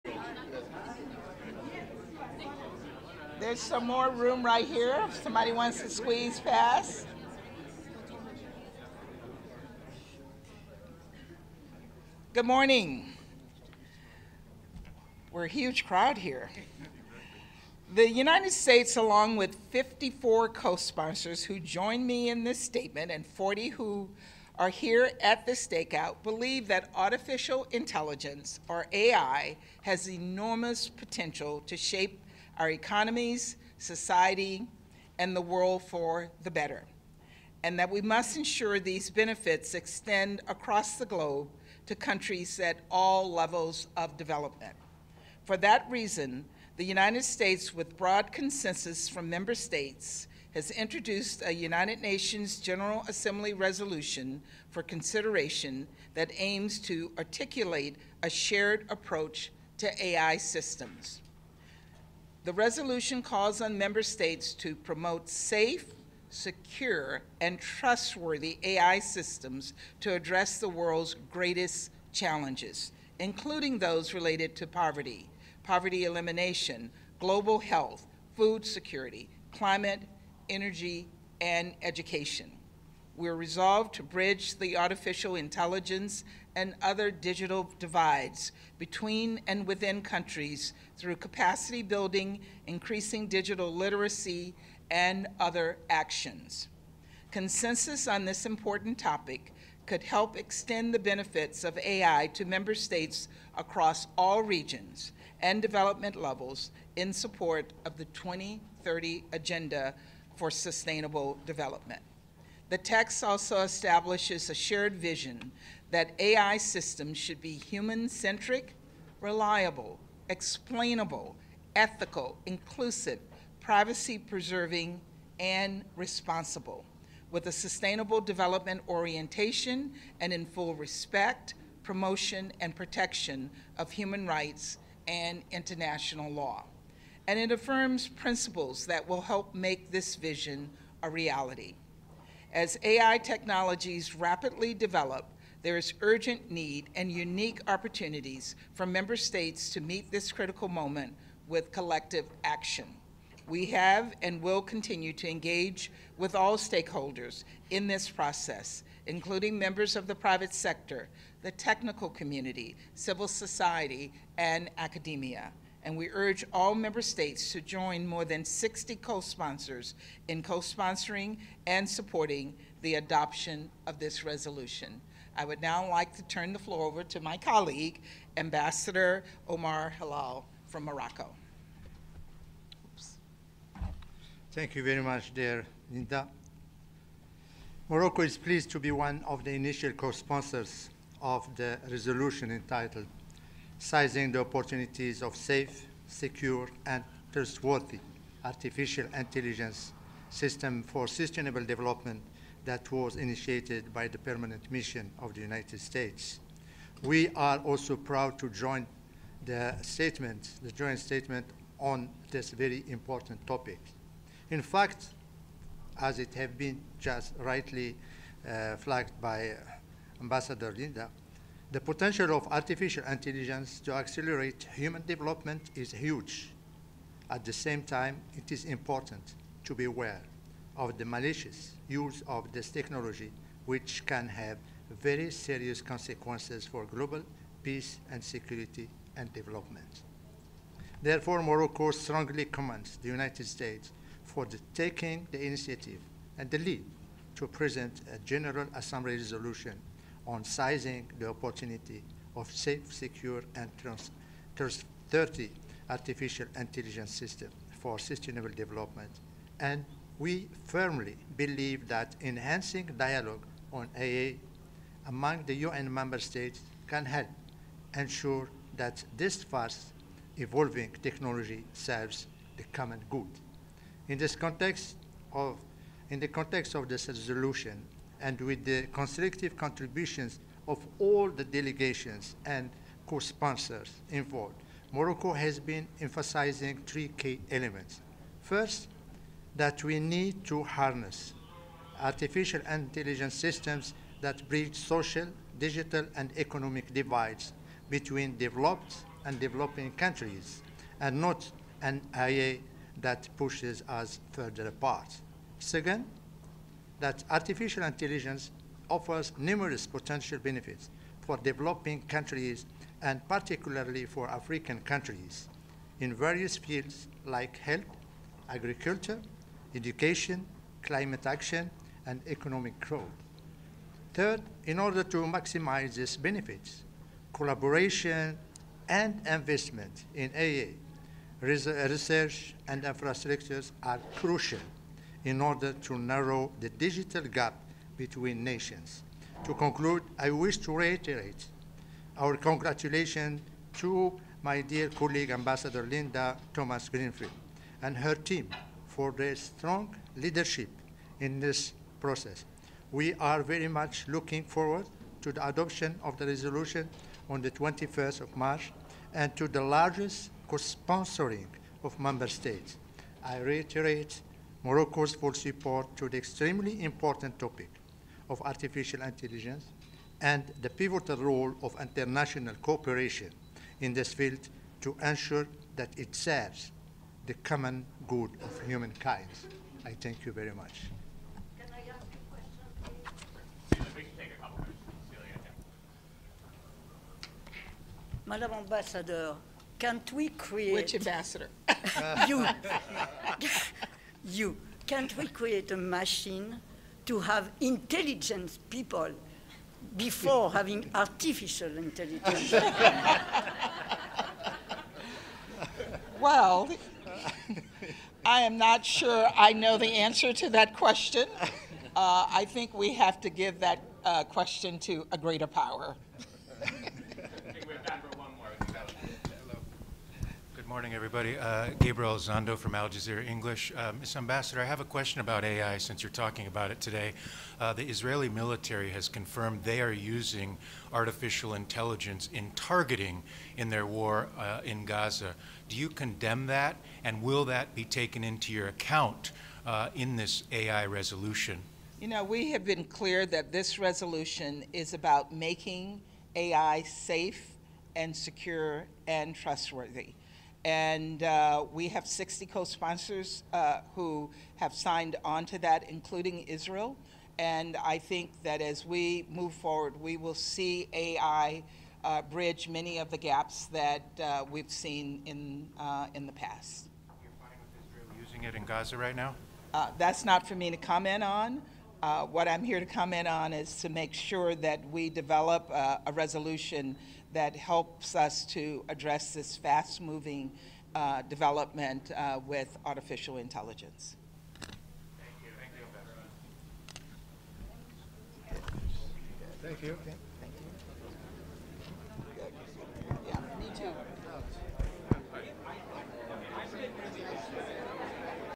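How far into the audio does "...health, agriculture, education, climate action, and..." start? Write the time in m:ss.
5:17.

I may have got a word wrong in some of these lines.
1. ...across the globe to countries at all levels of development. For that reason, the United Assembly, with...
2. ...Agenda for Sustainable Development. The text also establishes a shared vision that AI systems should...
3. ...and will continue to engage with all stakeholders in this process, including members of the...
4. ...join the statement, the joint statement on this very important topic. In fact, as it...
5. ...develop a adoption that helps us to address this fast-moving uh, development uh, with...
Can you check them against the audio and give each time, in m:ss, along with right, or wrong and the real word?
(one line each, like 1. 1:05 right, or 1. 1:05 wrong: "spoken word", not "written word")
1. 0:40 wrong: "States", not "Assembly"
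2. 1:49 right
3. 2:34 right
4. 3:28 right
5. 7:55 wrong: "resolution", not "adoption".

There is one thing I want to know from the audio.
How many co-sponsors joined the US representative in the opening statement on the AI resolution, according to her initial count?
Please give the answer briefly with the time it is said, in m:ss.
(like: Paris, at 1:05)
54, at 0:19.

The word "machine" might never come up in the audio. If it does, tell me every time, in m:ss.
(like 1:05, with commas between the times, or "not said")
6:35.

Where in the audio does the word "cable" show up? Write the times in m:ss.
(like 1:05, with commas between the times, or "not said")
not said.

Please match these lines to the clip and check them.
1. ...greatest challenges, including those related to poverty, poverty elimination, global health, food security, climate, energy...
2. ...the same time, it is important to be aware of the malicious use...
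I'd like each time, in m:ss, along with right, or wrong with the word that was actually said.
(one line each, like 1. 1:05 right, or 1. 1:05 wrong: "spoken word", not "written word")
1. 1:11 right
2. 3:47 right.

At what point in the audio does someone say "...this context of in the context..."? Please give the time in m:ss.
4:34.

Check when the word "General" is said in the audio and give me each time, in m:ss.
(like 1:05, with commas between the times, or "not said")
0:52, 4:08.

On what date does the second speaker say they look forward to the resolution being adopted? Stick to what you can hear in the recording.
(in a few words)
21st of March.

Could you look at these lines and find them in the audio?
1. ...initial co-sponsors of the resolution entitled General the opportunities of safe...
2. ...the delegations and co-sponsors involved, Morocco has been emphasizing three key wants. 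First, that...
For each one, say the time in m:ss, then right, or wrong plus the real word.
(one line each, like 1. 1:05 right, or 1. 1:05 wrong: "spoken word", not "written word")
1. 3:09 wrong: "Sizing", not "General"
2. 4:41 wrong: "elements", not "wants".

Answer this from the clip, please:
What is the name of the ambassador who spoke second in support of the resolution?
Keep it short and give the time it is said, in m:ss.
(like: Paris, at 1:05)
Omar Hilale, at 2:59.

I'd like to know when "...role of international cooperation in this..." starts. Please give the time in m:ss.
6:11.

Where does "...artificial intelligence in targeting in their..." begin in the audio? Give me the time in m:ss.
7:10.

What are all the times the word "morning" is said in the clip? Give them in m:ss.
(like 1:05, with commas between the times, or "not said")
0:12, 7:00.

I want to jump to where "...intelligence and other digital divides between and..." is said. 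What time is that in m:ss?
1:25.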